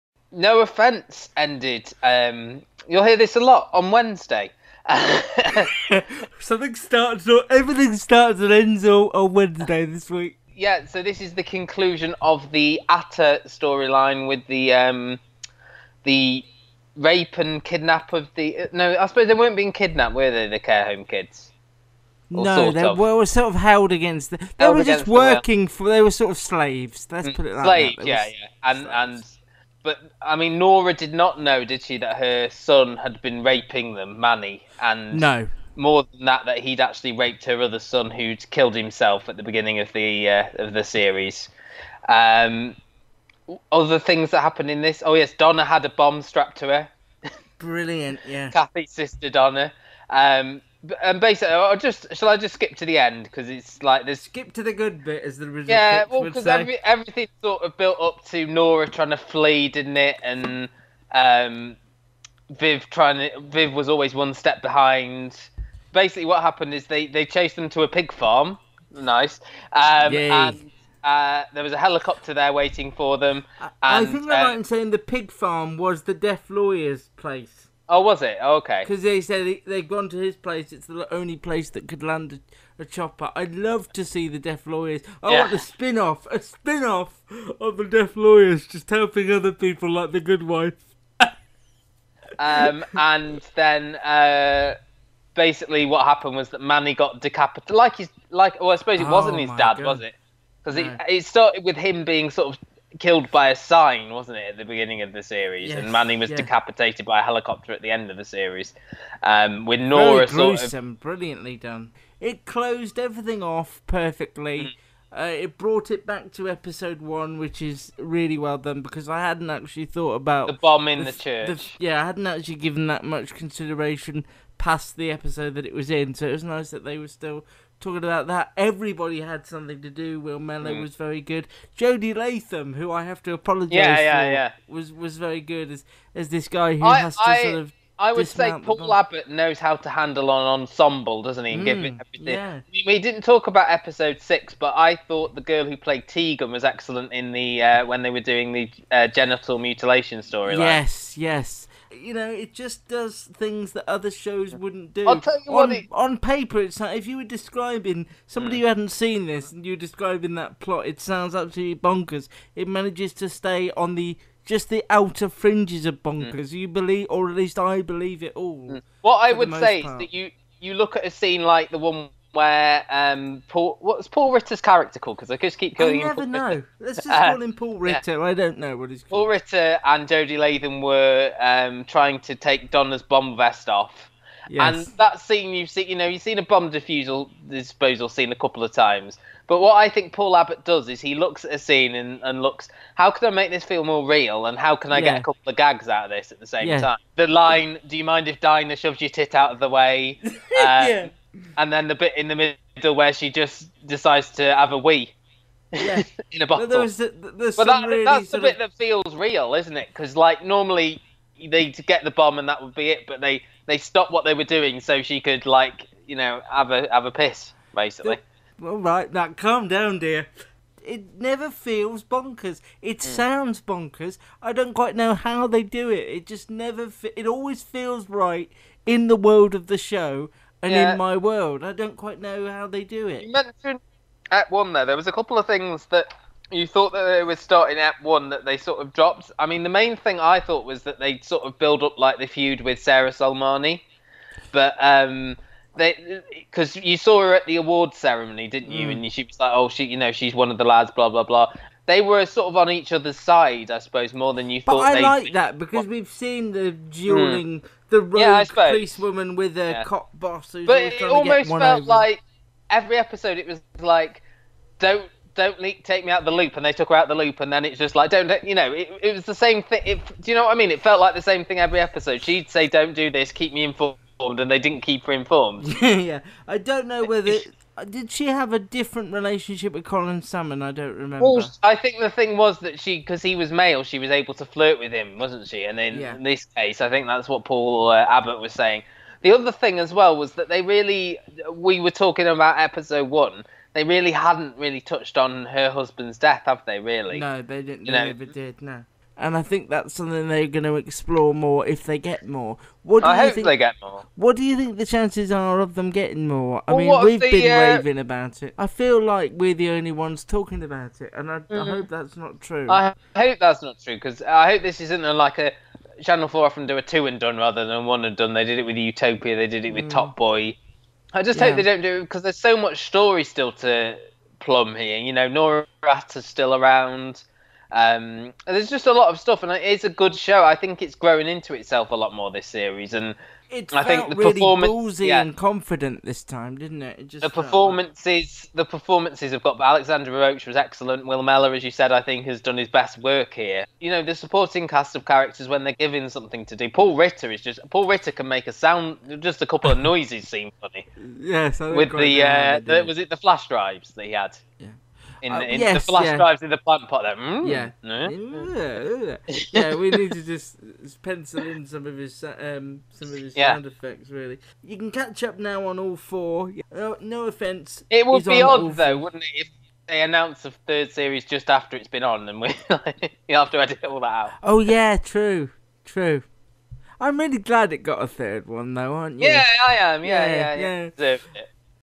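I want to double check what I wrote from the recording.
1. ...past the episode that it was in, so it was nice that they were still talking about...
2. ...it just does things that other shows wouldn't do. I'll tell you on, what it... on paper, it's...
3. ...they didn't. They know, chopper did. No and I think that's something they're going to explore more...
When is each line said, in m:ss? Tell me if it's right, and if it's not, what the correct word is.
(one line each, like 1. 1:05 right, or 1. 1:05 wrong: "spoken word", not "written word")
1. 2:04 right
2. 2:32 right
3. 4:57 wrong: "never", not "chopper".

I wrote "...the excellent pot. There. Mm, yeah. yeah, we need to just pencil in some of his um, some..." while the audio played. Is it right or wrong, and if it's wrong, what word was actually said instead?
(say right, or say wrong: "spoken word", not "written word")
wrong: "plant", not "excellent".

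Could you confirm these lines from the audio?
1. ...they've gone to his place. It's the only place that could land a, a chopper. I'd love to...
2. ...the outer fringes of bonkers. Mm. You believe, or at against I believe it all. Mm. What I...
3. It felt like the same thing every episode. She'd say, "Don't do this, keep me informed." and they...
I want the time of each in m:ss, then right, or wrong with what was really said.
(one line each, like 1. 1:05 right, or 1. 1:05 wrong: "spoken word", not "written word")
1. 1:19 right
2. 2:44 wrong: "least", not "against"
3. 4:30 right.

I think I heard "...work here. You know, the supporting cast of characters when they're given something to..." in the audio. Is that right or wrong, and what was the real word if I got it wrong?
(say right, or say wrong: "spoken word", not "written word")
right.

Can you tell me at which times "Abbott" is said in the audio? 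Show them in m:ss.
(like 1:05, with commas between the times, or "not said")
2:18, 3:10, 4:48.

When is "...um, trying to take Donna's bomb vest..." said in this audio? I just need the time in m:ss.
3:01.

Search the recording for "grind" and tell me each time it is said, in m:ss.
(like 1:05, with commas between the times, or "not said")
not said.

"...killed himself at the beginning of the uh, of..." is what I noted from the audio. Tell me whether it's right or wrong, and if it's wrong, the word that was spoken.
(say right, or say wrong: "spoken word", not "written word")
right.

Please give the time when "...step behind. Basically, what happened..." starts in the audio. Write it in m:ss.
1:04.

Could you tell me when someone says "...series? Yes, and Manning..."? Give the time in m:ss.
1:45.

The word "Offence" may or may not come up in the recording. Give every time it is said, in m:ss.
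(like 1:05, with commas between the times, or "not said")
0:00, 6:07.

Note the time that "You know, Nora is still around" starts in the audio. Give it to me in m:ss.
5:24.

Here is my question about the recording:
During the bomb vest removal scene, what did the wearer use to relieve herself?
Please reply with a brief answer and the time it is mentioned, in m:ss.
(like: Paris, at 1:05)
A bottle, at 3:26.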